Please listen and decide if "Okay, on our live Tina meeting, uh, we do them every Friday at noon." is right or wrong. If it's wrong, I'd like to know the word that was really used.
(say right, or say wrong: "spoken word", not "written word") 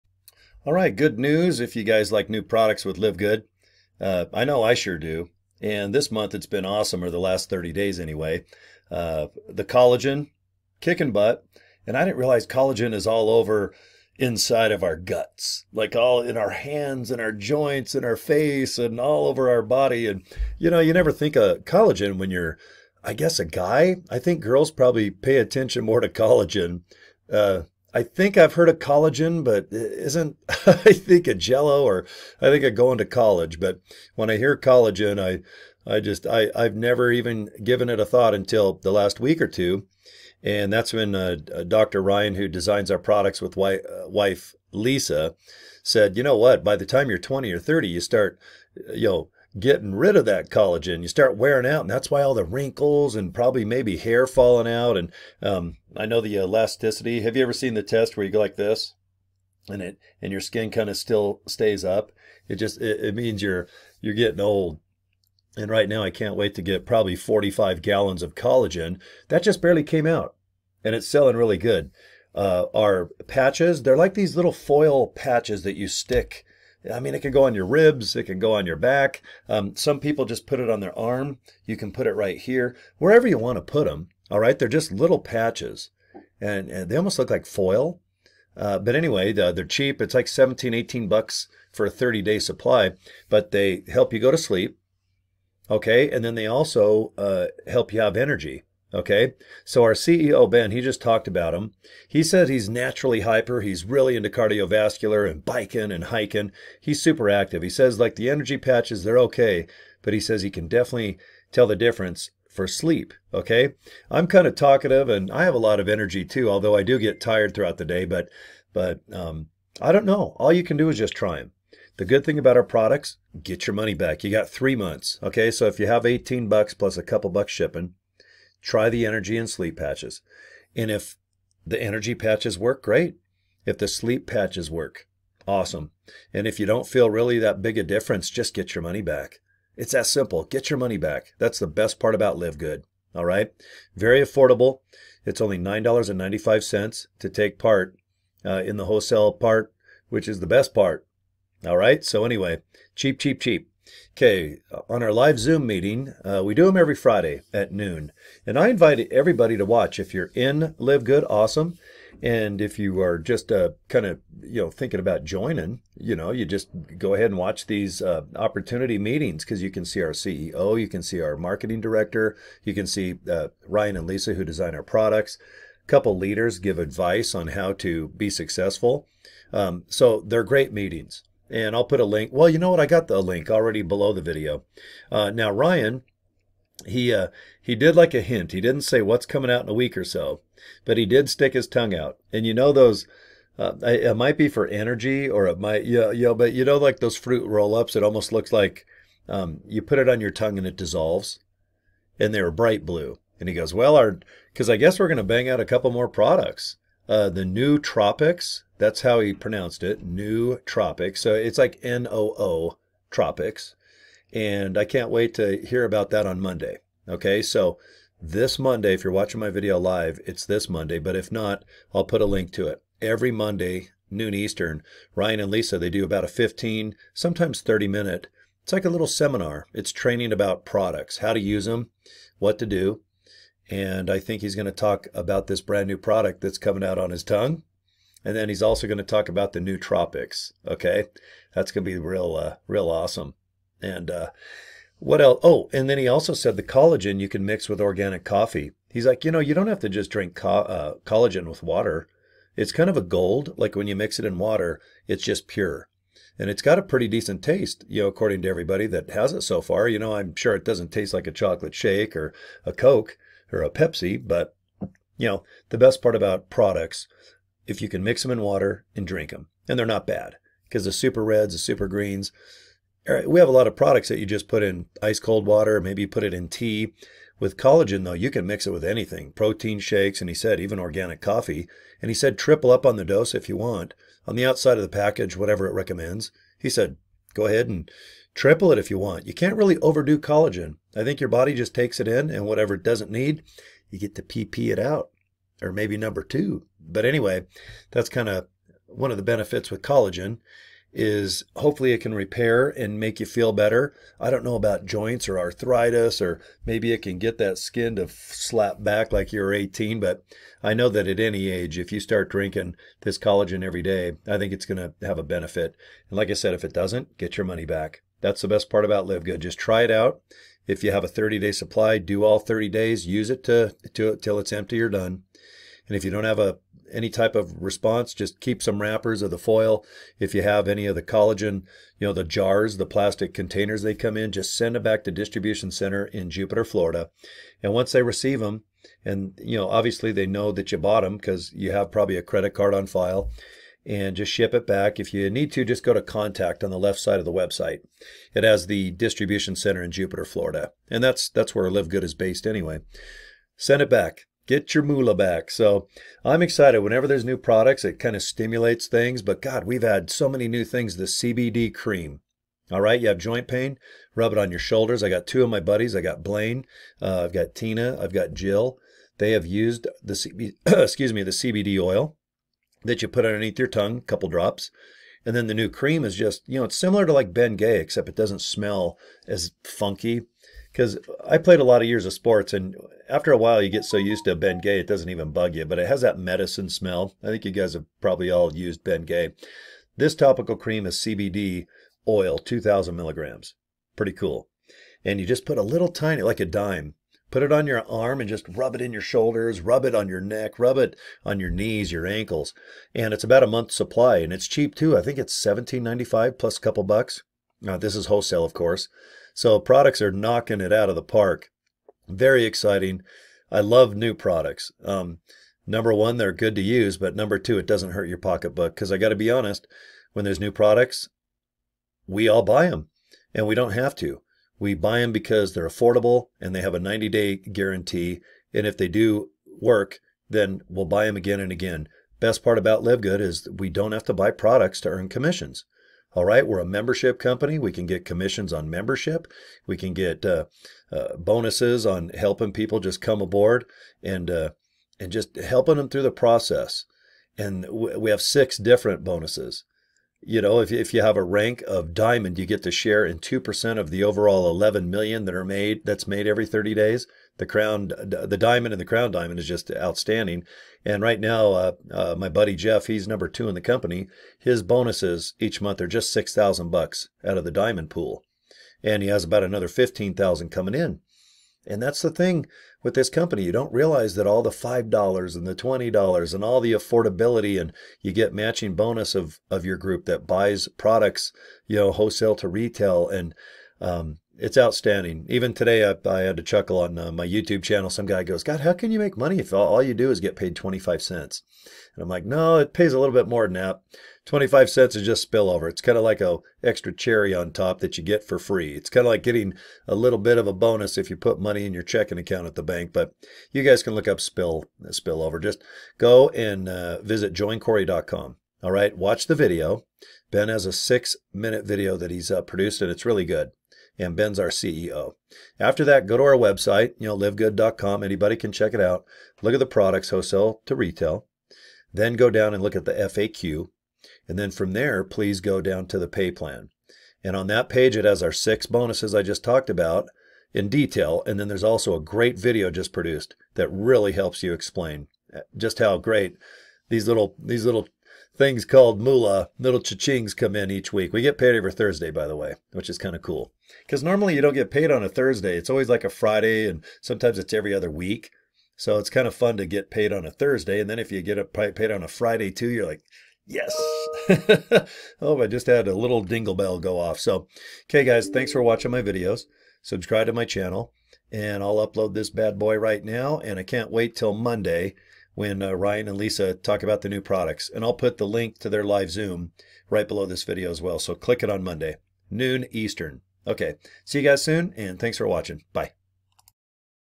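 wrong: "Zoom", not "Tina".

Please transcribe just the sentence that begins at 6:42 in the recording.
And it's about a month's supply and it's cheap too.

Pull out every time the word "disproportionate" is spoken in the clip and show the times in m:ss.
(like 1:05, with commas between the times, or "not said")
not said.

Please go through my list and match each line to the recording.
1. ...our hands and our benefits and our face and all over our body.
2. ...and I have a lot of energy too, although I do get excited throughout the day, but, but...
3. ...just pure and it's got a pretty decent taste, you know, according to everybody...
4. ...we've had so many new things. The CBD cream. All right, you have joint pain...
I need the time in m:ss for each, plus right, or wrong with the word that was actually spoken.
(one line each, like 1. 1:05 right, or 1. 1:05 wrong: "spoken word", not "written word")
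1. 0:16 wrong: "joints", not "benefits"
2. 1:55 wrong: "tired", not "excited"
3. 4:15 right
4. 5:59 right.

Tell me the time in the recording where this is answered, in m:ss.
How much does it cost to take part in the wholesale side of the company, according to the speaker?
2:25.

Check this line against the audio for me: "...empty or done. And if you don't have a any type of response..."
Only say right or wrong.
right.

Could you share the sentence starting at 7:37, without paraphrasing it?
The crown, the diamond and the crown diamond is just outstanding.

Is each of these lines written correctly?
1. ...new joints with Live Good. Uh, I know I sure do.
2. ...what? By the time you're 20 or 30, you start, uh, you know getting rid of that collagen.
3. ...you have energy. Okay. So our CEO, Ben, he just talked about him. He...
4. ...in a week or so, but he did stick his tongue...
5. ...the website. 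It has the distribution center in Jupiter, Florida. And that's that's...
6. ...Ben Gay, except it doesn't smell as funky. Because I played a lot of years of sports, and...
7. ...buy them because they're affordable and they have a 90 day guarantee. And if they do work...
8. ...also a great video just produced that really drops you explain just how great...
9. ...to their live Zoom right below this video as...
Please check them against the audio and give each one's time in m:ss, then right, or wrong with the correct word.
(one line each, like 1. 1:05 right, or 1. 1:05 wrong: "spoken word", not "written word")
1. 0:02 wrong: "products", not "joints"
2. 0:46 right
3. 1:37 right
4. 3:09 right
5. 5:47 right
6. 6:17 right
7. 7:04 right
8. 8:51 wrong: "helps", not "drops"
9. 9:28 right.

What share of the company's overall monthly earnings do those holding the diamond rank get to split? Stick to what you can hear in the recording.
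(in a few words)
2%.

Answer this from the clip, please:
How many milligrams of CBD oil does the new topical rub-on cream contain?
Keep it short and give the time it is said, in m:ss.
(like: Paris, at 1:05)
2,000, at 6:32.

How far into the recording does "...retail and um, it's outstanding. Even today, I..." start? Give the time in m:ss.
8:02.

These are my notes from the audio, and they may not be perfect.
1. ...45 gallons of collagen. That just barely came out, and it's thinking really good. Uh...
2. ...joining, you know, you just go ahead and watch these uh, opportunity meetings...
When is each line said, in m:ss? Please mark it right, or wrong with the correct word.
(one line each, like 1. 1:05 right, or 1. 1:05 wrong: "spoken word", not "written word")
1. 1:07 wrong: "selling", not "thinking"
2. 2:45 right.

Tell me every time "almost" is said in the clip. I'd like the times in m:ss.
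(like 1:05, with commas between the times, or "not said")
1:26, 3:18.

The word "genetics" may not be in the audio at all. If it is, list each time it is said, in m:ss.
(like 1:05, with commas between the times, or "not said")
not said.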